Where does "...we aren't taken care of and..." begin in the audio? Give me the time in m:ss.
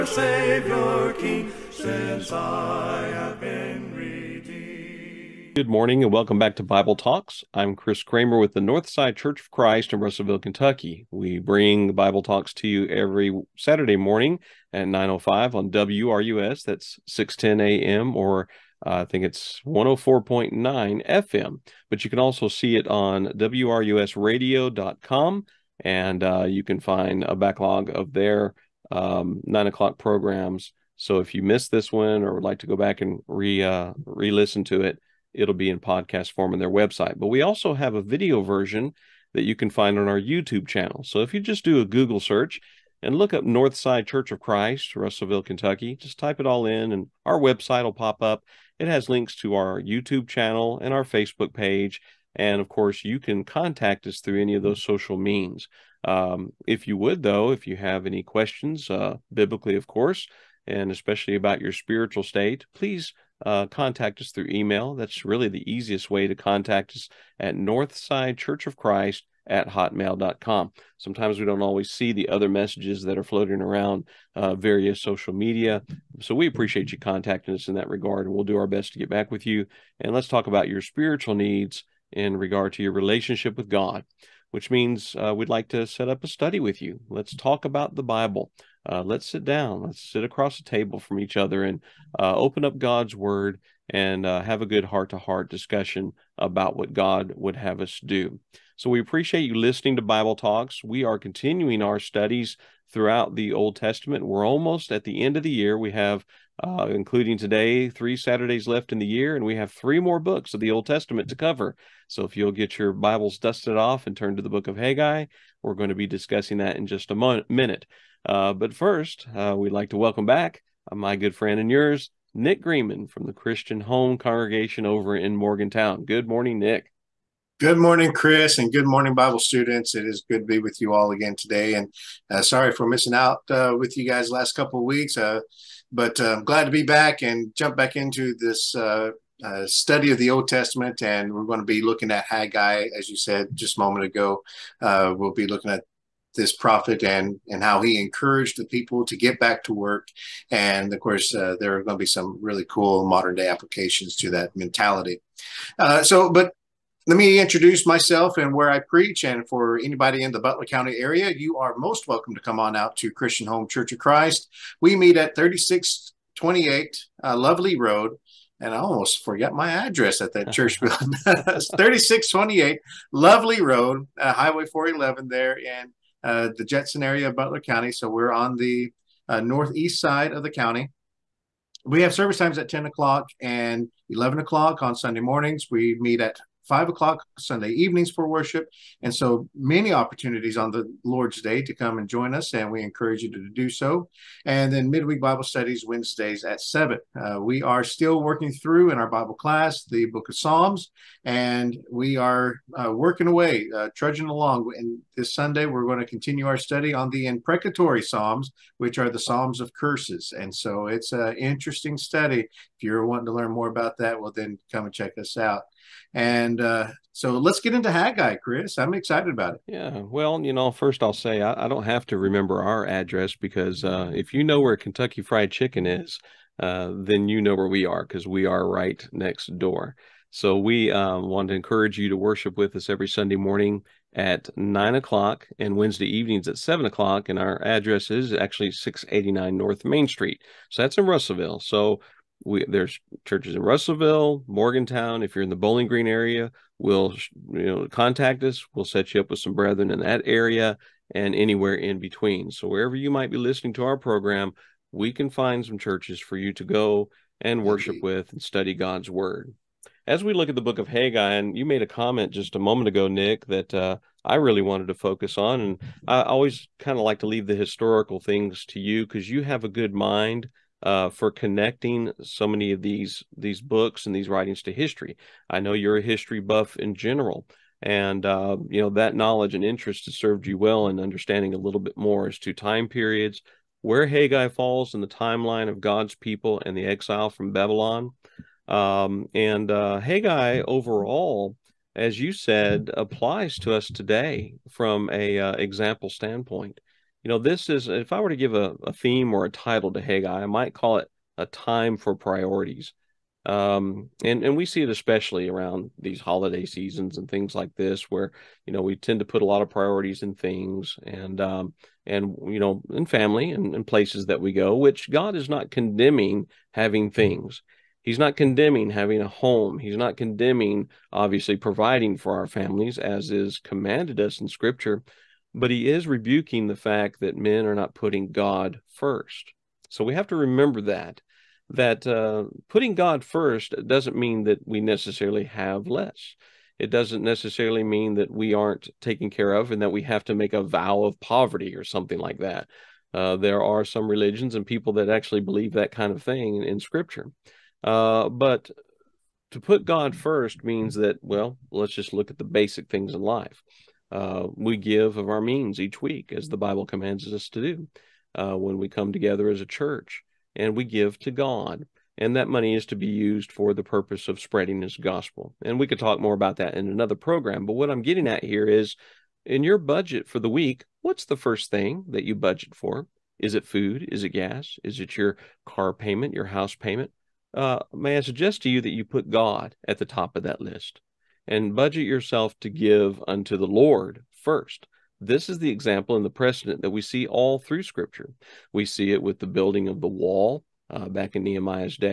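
5:38.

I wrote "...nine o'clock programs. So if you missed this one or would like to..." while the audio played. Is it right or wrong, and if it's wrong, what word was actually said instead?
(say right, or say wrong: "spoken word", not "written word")
right.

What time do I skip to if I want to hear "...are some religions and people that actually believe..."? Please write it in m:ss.
5:43.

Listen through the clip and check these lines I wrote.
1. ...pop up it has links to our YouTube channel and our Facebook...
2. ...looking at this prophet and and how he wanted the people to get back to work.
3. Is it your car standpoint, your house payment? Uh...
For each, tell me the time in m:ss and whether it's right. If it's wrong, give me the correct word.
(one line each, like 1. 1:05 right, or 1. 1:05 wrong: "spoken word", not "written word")
1. 0:47 right
2. 2:25 wrong: "encouraged", not "wanted"
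3. 6:14 wrong: "payment", not "standpoint".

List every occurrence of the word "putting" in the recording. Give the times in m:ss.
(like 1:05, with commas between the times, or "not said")
5:27, 5:32.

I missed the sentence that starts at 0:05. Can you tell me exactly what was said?
Good morning and welcome back to Bible Talks.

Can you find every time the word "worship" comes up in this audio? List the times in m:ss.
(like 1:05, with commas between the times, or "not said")
3:08, 3:52, 4:17.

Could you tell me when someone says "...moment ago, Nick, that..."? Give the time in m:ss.
4:22.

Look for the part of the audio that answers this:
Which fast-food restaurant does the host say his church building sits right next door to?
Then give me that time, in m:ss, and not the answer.
3:44.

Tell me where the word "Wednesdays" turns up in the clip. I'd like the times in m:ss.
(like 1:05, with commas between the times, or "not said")
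3:15, 3:55.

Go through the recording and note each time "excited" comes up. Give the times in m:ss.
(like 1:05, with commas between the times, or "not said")
3:38.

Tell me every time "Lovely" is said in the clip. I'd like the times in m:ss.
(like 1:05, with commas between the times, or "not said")
2:47, 2:53.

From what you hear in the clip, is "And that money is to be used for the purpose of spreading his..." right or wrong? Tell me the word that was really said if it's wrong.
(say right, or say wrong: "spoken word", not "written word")
right.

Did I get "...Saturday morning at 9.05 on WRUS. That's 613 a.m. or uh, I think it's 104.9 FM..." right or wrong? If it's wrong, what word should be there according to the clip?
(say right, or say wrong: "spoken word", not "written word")
wrong: "610", not "613".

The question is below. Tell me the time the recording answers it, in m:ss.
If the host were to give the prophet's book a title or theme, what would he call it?
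5:01.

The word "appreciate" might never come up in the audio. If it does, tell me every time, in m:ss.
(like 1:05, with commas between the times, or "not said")
1:16, 1:39.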